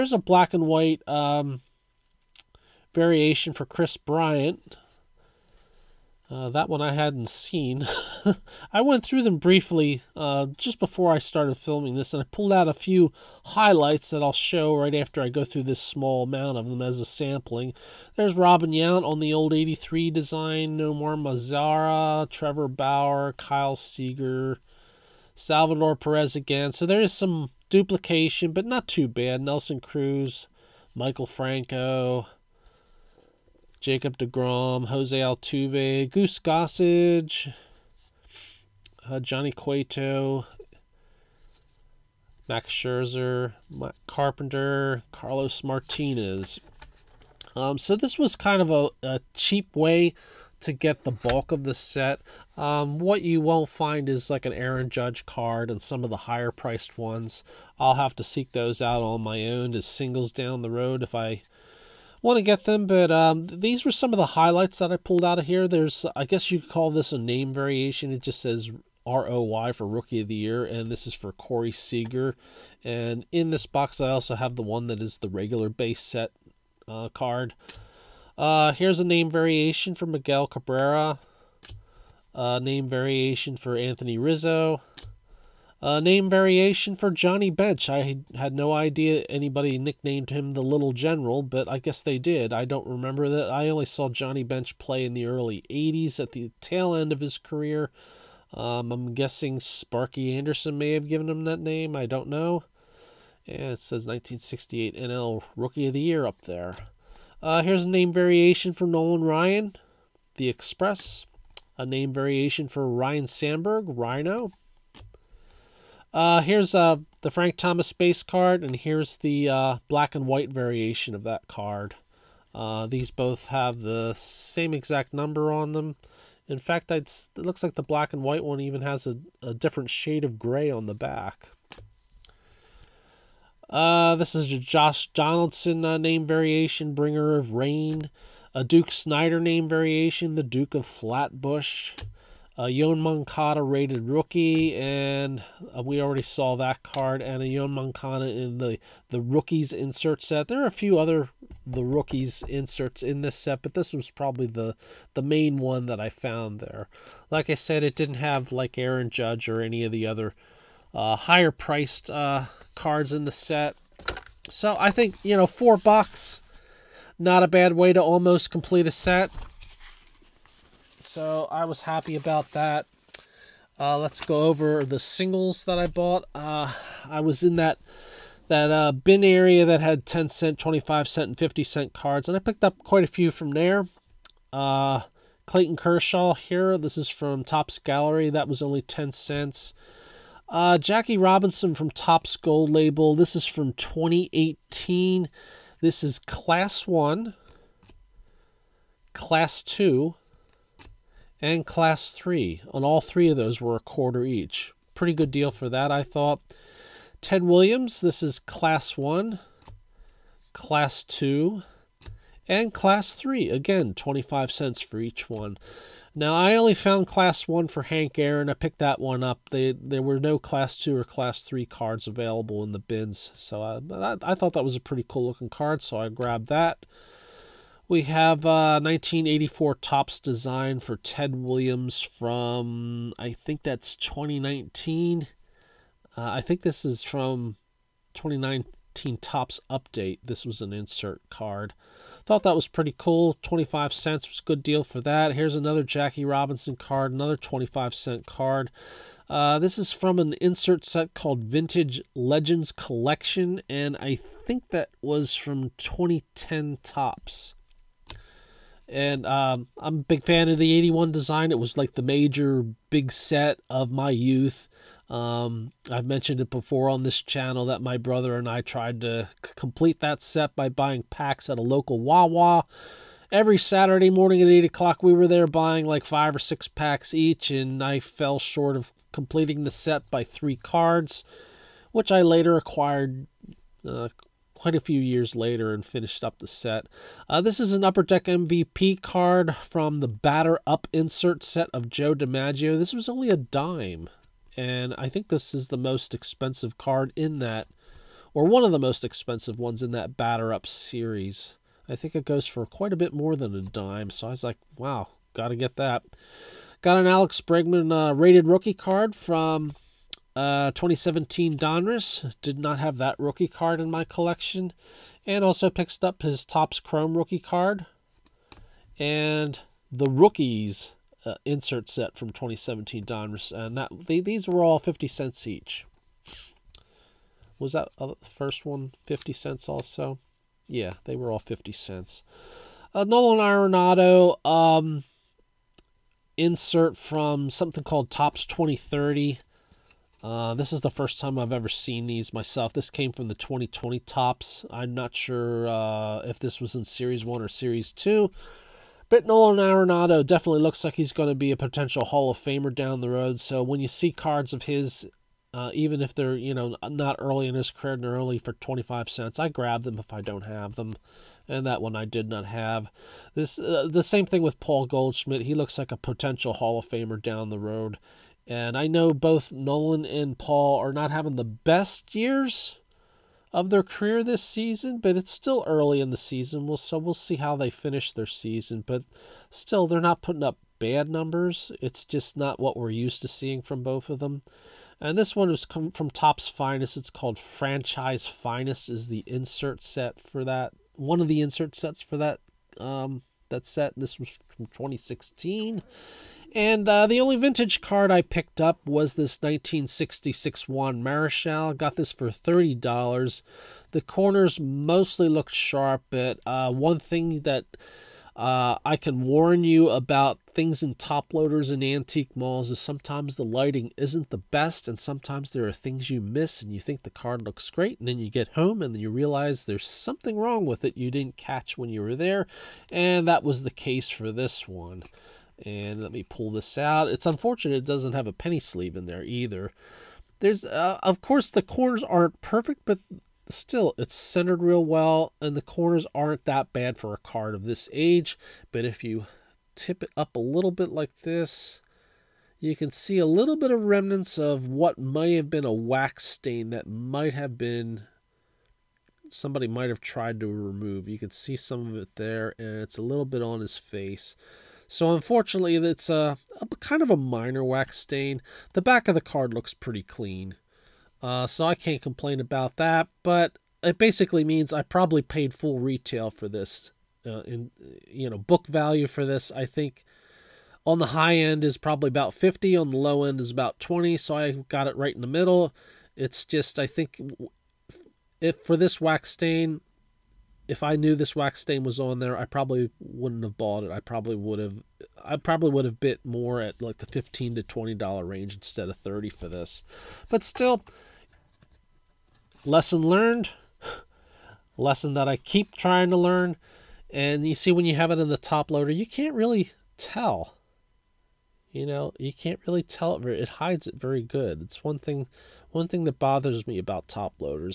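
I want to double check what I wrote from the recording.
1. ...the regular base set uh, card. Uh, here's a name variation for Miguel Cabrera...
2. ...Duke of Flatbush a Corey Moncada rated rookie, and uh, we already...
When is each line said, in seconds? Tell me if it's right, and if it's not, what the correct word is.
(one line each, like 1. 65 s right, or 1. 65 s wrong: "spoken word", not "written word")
1. 75 s right
2. 140 s wrong: "Yoan", not "Corey".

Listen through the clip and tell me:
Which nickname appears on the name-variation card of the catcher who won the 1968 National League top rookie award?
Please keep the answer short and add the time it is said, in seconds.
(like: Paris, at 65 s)
The Little General, at 90 s.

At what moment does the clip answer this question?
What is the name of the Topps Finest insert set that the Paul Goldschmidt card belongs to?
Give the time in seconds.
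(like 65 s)
387 s.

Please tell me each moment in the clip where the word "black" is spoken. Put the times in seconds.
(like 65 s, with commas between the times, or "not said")
0 s, 119 s, 127 s.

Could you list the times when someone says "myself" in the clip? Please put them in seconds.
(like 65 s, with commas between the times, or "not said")
342 s.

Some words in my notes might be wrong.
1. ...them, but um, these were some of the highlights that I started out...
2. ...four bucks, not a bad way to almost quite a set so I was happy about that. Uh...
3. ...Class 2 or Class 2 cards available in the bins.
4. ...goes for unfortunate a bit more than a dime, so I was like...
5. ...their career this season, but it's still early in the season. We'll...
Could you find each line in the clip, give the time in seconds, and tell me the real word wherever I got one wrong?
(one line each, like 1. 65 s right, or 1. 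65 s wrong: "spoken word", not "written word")
1. 62 s wrong: "pulled", not "started"
2. 165 s wrong: "complete", not "quite"
3. 220 s wrong: "3", not "2"
4. 302 s wrong: "quite", not "unfortunate"
5. 373 s right.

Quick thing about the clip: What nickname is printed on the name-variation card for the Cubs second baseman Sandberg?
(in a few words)
Rhino.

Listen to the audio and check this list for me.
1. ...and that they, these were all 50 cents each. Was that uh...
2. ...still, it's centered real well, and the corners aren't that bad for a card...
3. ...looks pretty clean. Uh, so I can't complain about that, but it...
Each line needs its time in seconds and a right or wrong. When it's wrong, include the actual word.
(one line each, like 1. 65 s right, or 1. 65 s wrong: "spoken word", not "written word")
1. 323 s right
2. 433 s right
3. 459 s right.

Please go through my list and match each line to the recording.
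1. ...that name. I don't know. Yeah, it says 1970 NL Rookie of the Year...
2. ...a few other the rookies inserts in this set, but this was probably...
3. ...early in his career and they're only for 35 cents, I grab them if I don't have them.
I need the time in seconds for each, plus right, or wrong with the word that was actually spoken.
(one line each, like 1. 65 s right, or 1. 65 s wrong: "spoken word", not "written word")
1. 101 s wrong: "1968", not "1970"
2. 150 s right
3. 357 s wrong: "25", not "35".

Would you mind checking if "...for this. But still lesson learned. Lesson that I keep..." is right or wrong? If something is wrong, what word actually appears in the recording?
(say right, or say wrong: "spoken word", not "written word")
right.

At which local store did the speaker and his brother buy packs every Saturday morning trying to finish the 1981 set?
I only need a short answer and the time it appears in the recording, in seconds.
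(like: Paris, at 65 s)
Wawa, at 271 s.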